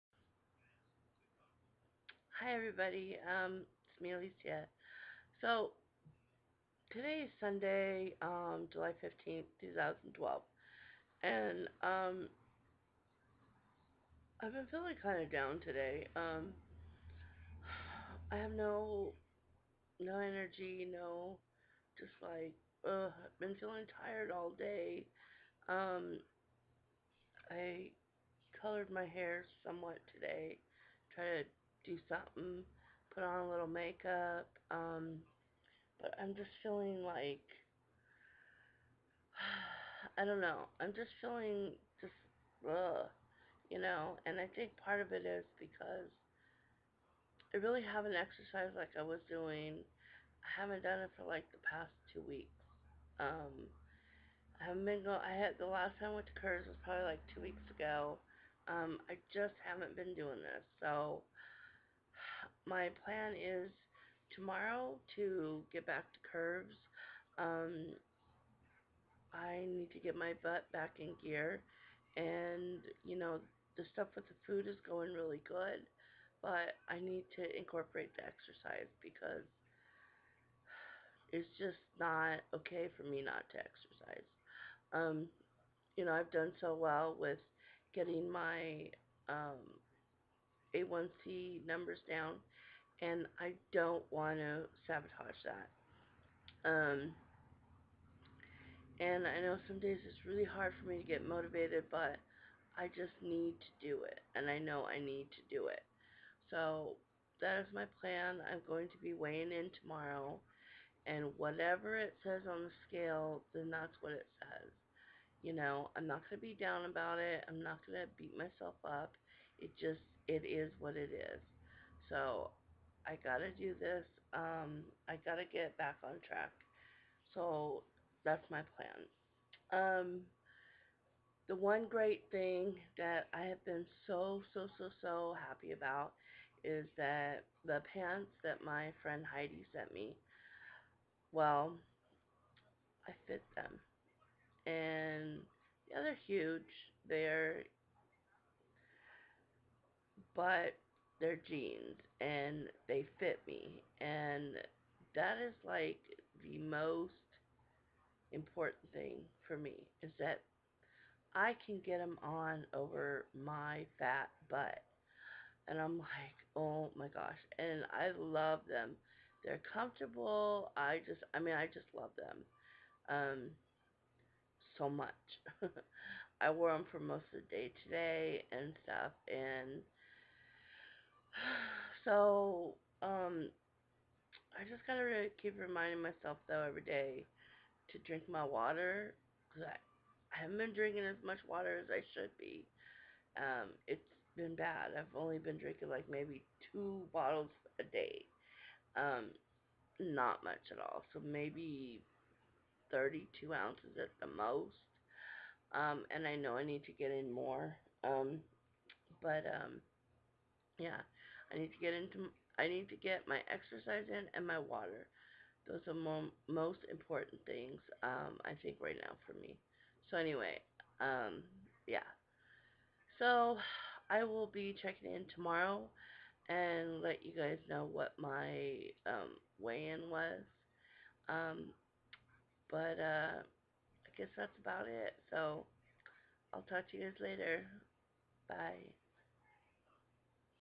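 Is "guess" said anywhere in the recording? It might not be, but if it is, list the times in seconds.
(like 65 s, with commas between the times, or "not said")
234 s.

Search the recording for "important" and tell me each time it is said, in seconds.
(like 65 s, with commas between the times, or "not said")
158 s, 216 s.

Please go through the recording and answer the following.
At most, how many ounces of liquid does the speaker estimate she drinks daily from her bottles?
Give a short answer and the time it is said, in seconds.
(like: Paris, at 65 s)
32 ounces, at 202 s.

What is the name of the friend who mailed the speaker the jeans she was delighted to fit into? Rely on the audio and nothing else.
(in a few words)
Heidi.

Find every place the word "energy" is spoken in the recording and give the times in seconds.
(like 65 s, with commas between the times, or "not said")
20 s.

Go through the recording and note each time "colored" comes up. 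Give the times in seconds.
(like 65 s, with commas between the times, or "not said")
28 s.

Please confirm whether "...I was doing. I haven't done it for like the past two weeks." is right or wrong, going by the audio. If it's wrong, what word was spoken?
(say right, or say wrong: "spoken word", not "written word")
right.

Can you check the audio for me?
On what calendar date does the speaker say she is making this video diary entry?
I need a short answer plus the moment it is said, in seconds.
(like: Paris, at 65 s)
July 15, 2012, at 8 s.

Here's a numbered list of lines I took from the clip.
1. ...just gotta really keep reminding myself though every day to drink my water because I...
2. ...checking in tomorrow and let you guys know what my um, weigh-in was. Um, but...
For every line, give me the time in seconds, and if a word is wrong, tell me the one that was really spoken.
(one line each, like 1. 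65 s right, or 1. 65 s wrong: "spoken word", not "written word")
1. 184 s right
2. 224 s right.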